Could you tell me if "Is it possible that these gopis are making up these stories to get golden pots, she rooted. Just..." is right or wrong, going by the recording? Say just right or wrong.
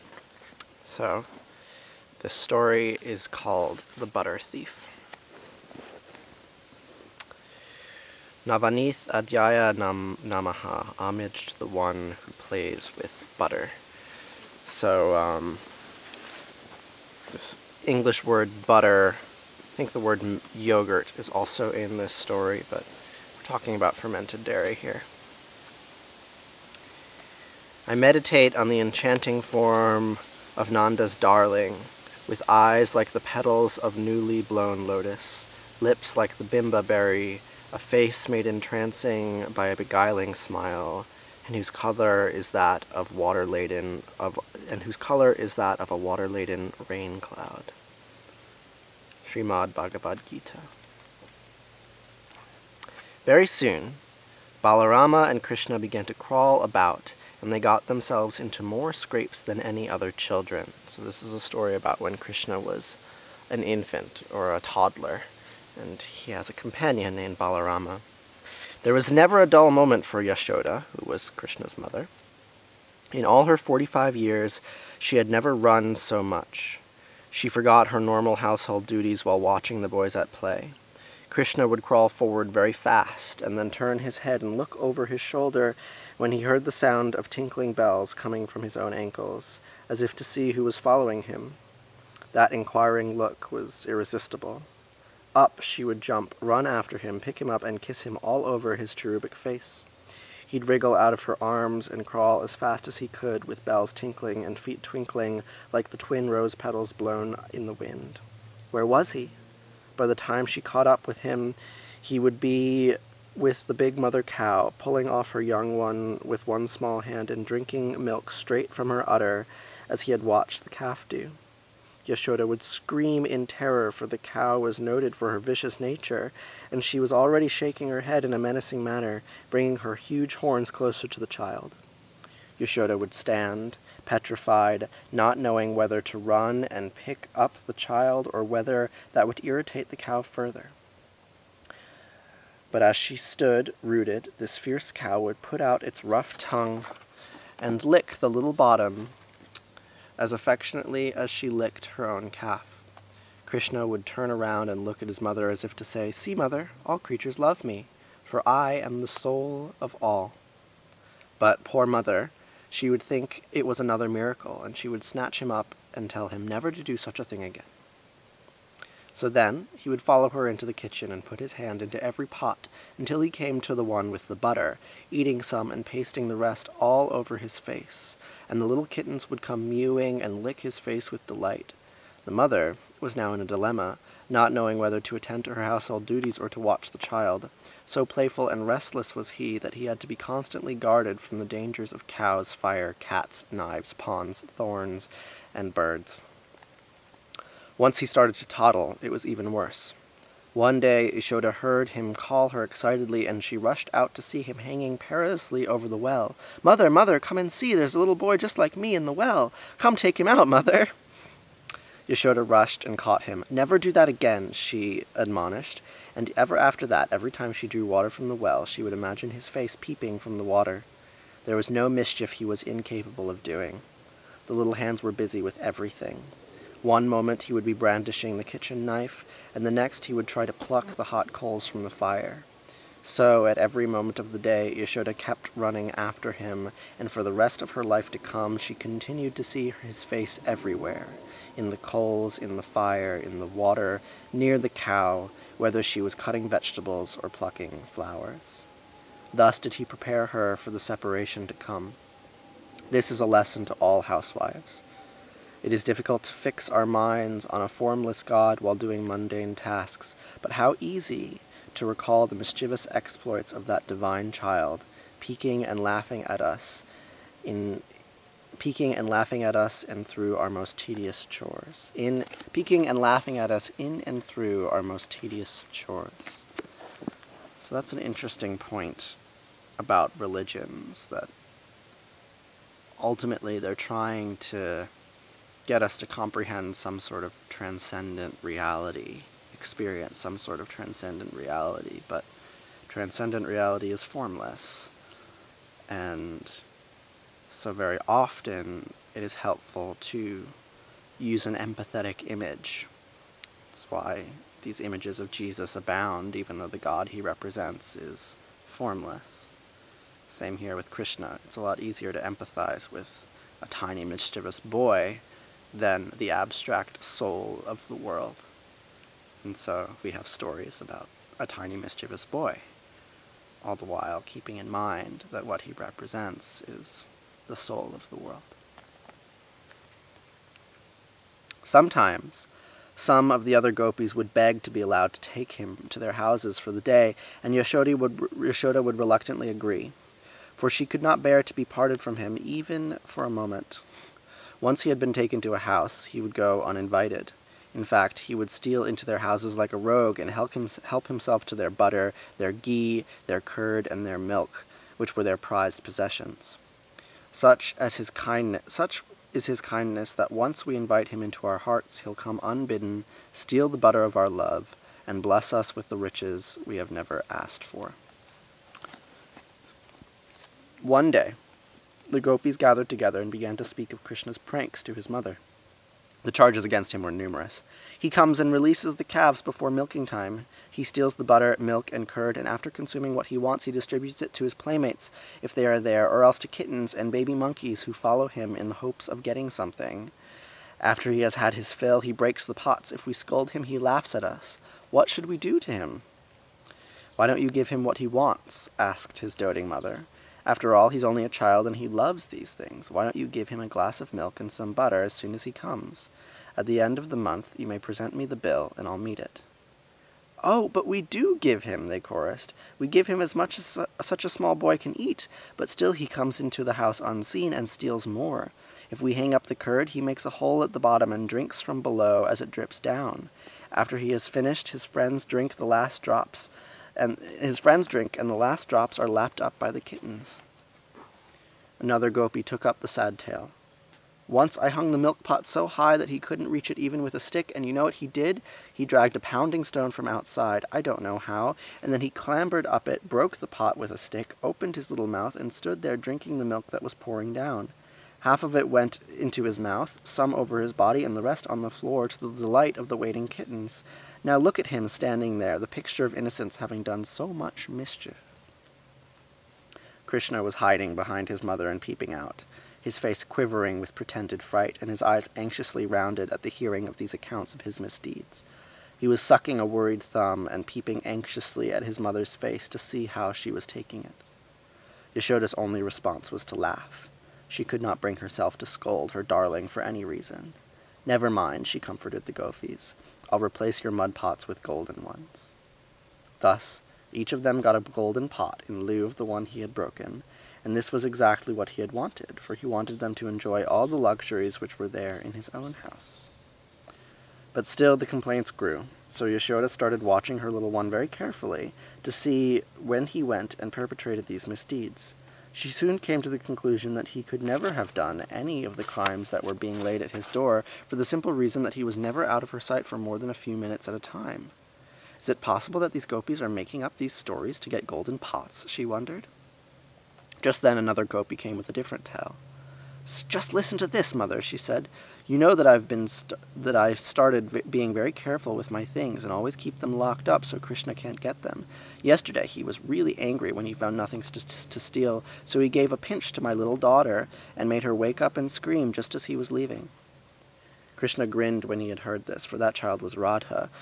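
wrong.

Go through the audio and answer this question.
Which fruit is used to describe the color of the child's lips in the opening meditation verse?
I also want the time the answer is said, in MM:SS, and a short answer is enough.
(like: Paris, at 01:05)
bimba berry, at 00:36.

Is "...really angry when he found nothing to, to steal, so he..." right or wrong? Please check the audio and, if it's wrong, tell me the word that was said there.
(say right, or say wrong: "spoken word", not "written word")
right.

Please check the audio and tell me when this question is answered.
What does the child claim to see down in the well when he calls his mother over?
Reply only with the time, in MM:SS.
03:27.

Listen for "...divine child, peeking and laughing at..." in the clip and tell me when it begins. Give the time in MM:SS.
04:23.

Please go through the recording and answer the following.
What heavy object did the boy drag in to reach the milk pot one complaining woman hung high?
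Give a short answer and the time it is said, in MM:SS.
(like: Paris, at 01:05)
pounding stone, at 07:19.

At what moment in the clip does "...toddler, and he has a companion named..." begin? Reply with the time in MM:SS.
01:04.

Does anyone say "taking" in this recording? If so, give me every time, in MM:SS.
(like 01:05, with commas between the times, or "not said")
07:53.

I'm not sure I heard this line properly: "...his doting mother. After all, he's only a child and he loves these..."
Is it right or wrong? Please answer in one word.
right.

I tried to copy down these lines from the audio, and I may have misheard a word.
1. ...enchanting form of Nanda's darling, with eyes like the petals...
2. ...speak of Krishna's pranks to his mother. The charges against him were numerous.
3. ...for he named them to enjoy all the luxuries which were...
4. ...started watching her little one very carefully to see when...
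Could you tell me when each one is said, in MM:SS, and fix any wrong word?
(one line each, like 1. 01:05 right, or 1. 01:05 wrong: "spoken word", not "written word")
1. 00:28 right
2. 06:13 right
3. 08:12 wrong: "wanted", not "named"
4. 08:19 right.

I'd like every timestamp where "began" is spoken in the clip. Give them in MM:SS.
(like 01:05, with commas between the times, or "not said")
00:55, 06:13.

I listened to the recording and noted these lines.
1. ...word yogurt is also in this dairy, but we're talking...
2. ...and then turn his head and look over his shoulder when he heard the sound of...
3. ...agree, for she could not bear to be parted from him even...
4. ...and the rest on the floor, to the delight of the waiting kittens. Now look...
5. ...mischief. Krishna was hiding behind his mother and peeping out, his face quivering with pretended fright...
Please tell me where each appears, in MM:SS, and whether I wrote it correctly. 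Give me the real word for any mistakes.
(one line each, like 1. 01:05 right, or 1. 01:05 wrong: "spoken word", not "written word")
1. 00:20 wrong: "story", not "dairy"
2. 01:23 right
3. 05:39 right
4. 07:31 right
5. 07:37 right.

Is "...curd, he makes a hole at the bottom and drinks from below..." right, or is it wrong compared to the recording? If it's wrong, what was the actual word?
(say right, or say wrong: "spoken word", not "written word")
right.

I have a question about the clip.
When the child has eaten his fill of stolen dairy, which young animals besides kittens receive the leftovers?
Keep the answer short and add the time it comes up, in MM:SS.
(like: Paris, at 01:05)
baby monkeys, at 06:27.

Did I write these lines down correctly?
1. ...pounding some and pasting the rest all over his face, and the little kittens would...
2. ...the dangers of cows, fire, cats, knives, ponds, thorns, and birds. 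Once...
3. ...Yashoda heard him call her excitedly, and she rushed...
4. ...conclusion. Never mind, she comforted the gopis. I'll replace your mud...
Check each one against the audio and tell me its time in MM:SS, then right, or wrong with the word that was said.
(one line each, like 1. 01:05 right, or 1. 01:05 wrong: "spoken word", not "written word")
1. 02:55 wrong: "eating", not "pounding"
2. 03:11 right
3. 03:21 right
4. 08:00 wrong: "reason", not "conclusion".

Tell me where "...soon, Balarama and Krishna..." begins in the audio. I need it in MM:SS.
00:53.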